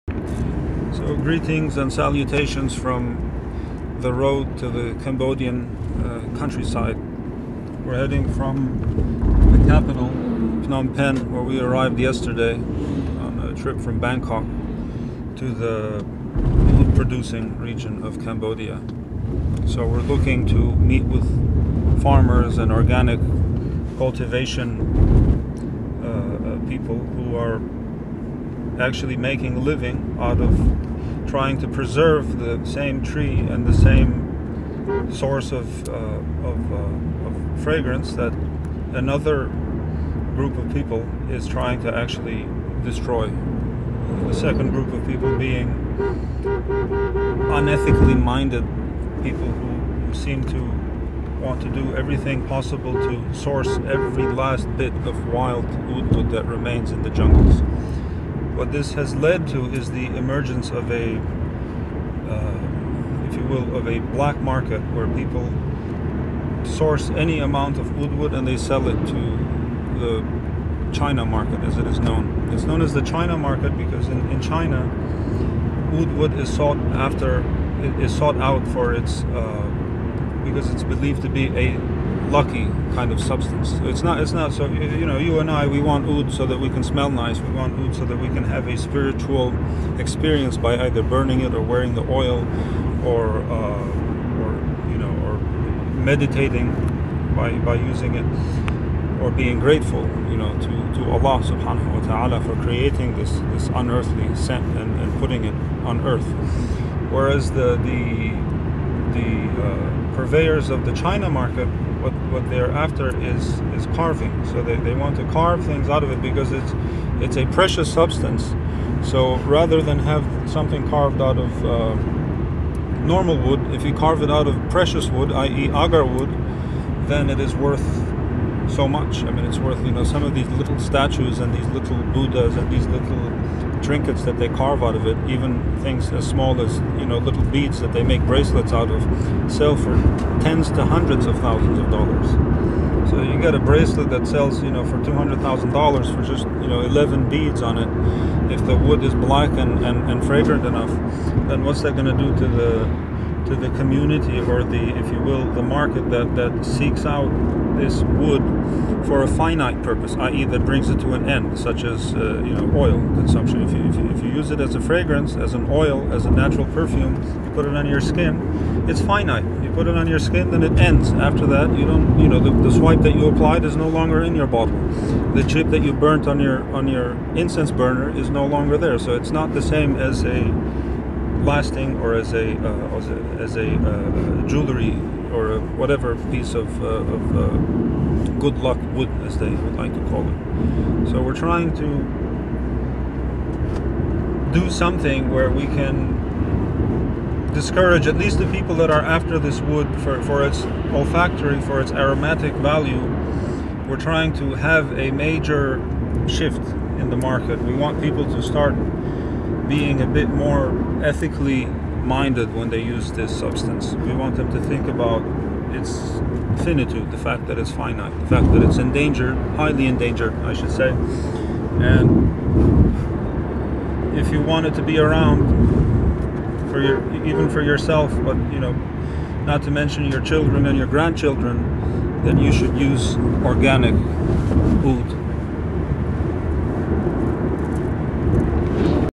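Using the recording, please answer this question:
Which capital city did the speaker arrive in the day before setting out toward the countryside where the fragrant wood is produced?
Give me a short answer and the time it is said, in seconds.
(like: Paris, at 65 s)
Phnom Penh, at 10 s.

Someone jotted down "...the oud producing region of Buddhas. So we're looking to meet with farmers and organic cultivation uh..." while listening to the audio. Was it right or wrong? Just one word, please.
wrong.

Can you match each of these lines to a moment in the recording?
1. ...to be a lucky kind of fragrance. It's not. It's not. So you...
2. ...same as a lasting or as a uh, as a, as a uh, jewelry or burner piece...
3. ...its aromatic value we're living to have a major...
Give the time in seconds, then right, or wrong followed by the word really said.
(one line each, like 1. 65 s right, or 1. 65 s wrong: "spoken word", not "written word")
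1. 81 s wrong: "substance", not "fragrance"
2. 179 s wrong: "whatever", not "burner"
3. 201 s wrong: "trying", not "living".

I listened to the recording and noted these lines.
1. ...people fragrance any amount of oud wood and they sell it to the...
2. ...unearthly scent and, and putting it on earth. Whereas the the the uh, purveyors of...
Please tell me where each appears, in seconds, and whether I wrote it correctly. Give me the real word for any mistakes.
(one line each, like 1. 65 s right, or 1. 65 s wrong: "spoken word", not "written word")
1. 65 s wrong: "source", not "fragrance"
2. 103 s right.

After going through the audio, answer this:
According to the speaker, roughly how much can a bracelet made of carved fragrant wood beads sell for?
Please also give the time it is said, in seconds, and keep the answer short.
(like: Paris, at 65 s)
$200,000, at 145 s.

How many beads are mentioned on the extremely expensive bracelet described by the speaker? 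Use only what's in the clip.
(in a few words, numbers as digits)
11.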